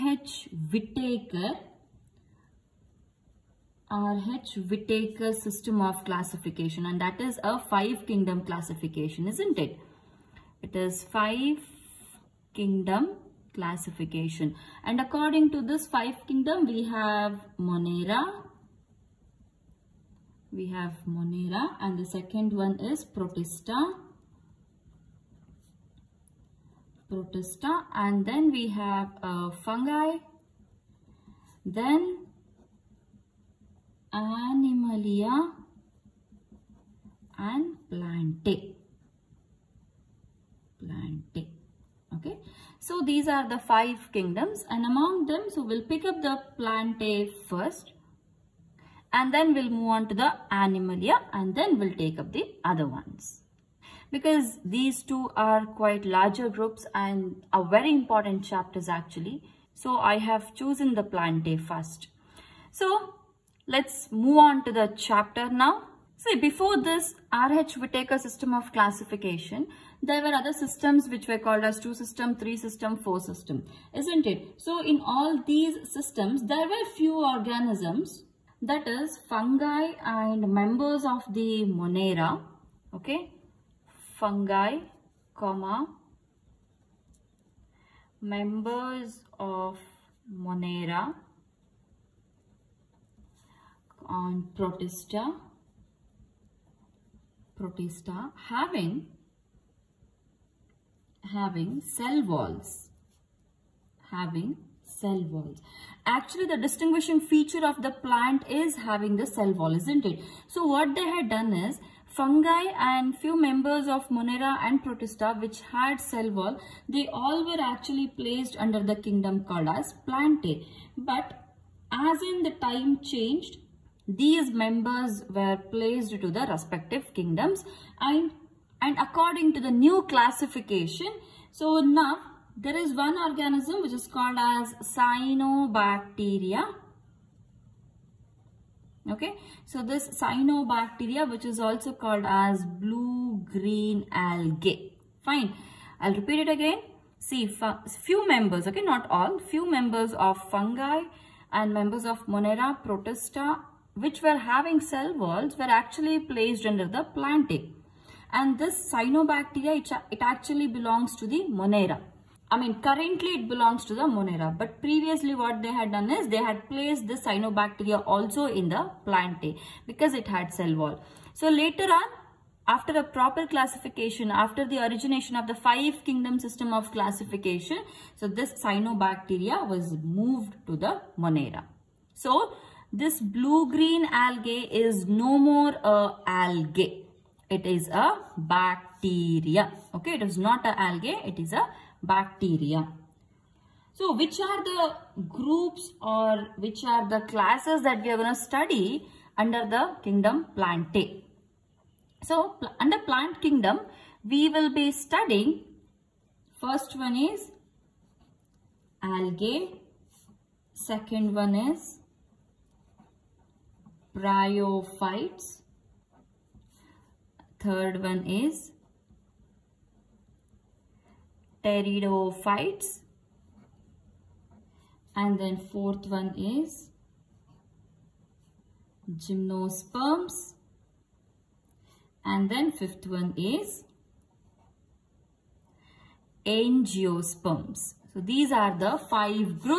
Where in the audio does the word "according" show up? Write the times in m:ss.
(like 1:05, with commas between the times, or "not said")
0:14, 2:08.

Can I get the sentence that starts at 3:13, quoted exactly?
So which are the groups or which are the classes that we are going to study under the kingdom plantae?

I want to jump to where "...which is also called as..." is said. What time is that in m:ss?
2:21.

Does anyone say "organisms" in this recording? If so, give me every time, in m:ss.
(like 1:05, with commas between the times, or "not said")
1:17, 2:13.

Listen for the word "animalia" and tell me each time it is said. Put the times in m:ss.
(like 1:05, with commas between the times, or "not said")
0:34, 0:50.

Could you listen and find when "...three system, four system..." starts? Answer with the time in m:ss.
1:12.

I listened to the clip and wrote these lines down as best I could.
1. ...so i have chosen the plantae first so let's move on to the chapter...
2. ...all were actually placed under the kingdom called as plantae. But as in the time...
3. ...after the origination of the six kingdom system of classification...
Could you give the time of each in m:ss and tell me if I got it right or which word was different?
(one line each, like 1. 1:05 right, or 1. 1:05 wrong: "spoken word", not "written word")
1. 0:59 right
2. 1:57 right
3. 2:54 wrong: "five", not "six".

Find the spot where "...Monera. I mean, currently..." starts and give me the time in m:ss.
2:41.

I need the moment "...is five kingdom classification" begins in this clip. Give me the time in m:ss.
0:10.